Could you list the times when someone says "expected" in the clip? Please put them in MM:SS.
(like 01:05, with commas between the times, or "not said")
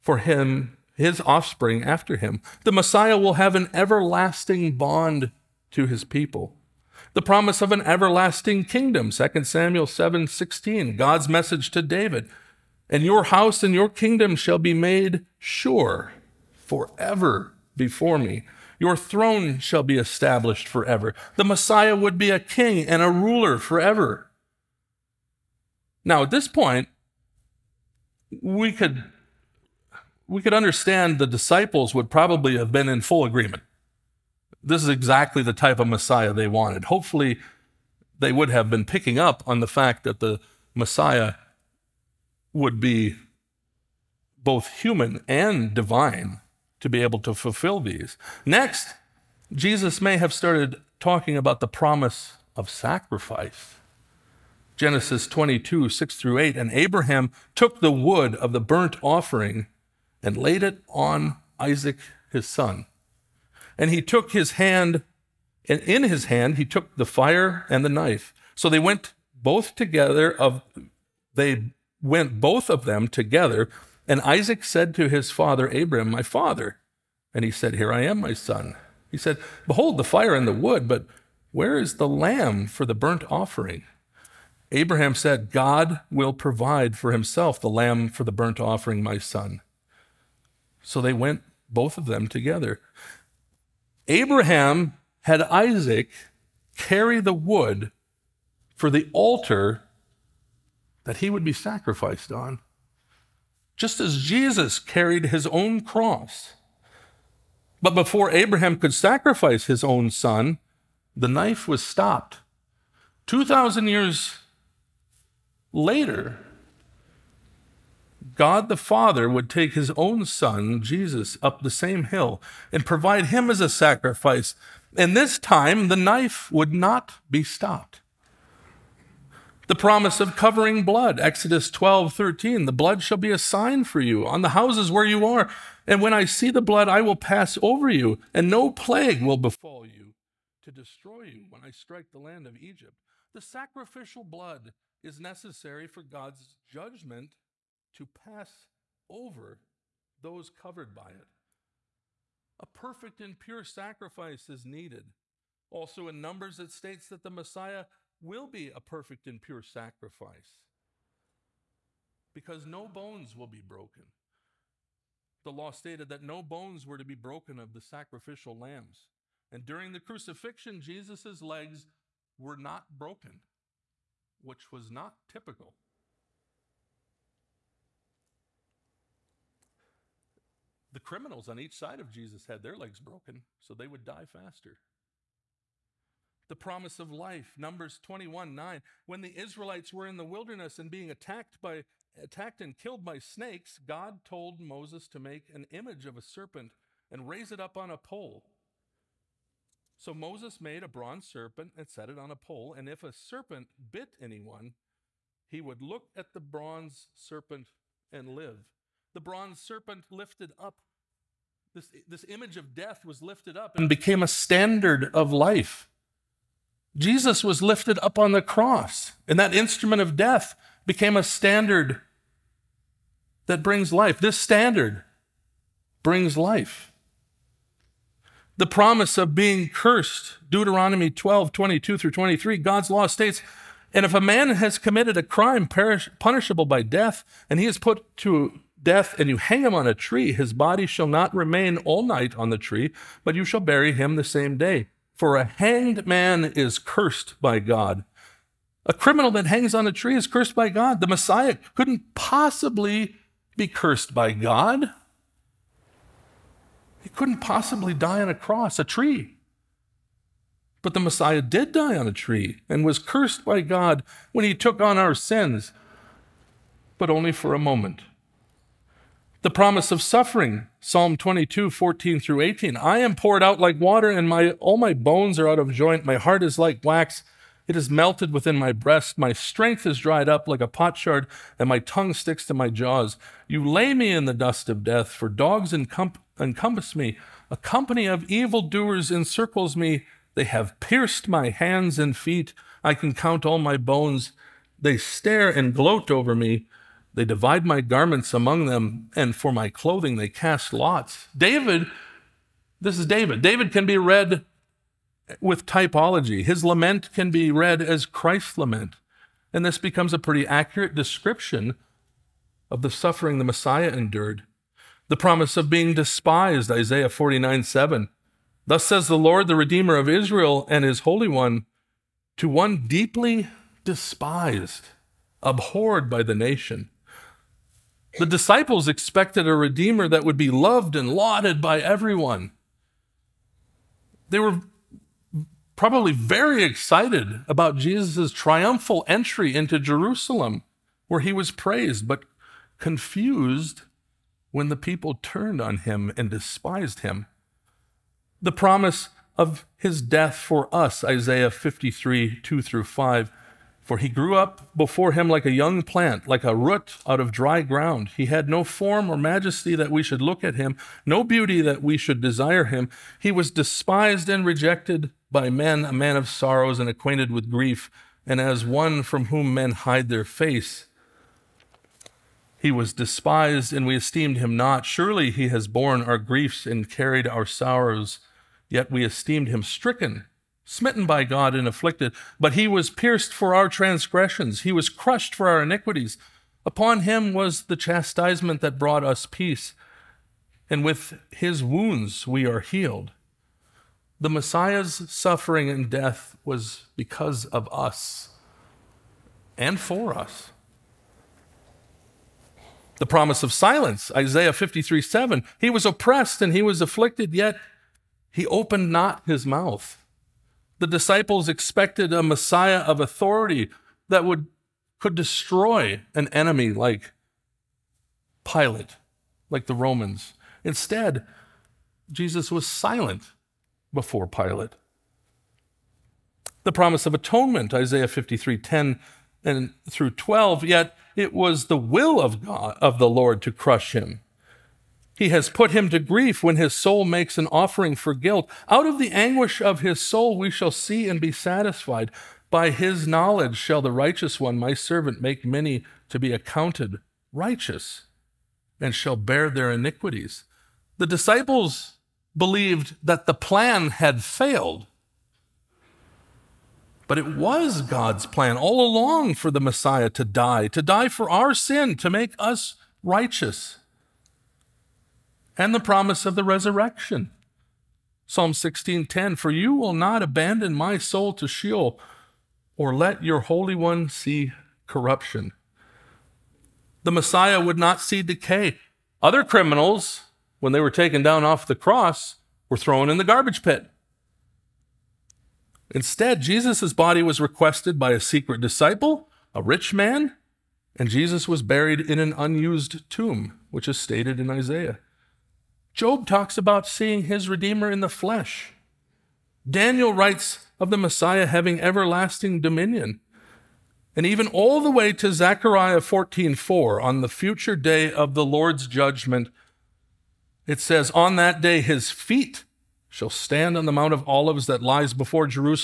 05:28, 06:51.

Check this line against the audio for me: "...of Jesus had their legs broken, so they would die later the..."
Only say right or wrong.
wrong.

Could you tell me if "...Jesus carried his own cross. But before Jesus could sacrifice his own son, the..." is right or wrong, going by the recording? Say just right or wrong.
wrong.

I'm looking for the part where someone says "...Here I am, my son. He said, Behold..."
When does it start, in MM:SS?
01:17.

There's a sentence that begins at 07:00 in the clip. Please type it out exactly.
Instead, Jesus was silent before Pilate.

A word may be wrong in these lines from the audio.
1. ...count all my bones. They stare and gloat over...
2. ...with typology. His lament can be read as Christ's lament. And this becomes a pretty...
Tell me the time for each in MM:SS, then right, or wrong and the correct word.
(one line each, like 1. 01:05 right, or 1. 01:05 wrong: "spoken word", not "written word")
1. 04:53 right
2. 05:05 right.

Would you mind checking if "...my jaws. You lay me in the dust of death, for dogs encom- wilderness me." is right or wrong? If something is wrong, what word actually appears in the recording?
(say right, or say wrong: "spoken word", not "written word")
wrong: "encompass", not "wilderness".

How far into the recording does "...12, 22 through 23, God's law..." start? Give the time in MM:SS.
03:51.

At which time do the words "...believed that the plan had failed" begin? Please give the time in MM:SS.
07:32.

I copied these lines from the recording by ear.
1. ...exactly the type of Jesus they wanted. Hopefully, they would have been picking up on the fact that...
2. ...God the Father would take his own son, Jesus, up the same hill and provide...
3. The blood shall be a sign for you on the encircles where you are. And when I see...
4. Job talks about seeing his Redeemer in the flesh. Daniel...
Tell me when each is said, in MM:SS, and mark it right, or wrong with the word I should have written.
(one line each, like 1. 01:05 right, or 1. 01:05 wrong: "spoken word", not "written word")
1. 00:34 wrong: "Messiah", not "Jesus"
2. 01:58 right
3. 02:12 wrong: "houses", not "encircles"
4. 08:15 right.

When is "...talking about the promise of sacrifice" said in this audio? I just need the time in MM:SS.
00:51.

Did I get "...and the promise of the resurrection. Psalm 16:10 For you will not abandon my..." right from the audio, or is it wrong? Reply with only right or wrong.
right.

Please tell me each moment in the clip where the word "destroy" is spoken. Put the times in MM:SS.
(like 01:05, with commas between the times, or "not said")
02:20, 06:55.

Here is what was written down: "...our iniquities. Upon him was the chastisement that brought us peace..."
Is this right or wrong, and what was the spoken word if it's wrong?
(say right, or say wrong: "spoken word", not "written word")
right.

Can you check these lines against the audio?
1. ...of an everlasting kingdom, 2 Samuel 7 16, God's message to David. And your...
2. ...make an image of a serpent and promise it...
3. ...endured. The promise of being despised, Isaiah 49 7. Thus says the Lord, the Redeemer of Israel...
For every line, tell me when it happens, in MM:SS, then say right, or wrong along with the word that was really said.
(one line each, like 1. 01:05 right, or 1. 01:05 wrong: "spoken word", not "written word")
1. 00:07 right
2. 03:15 wrong: "raise", not "promise"
3. 05:13 right.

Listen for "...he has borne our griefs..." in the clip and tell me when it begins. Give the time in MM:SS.
06:15.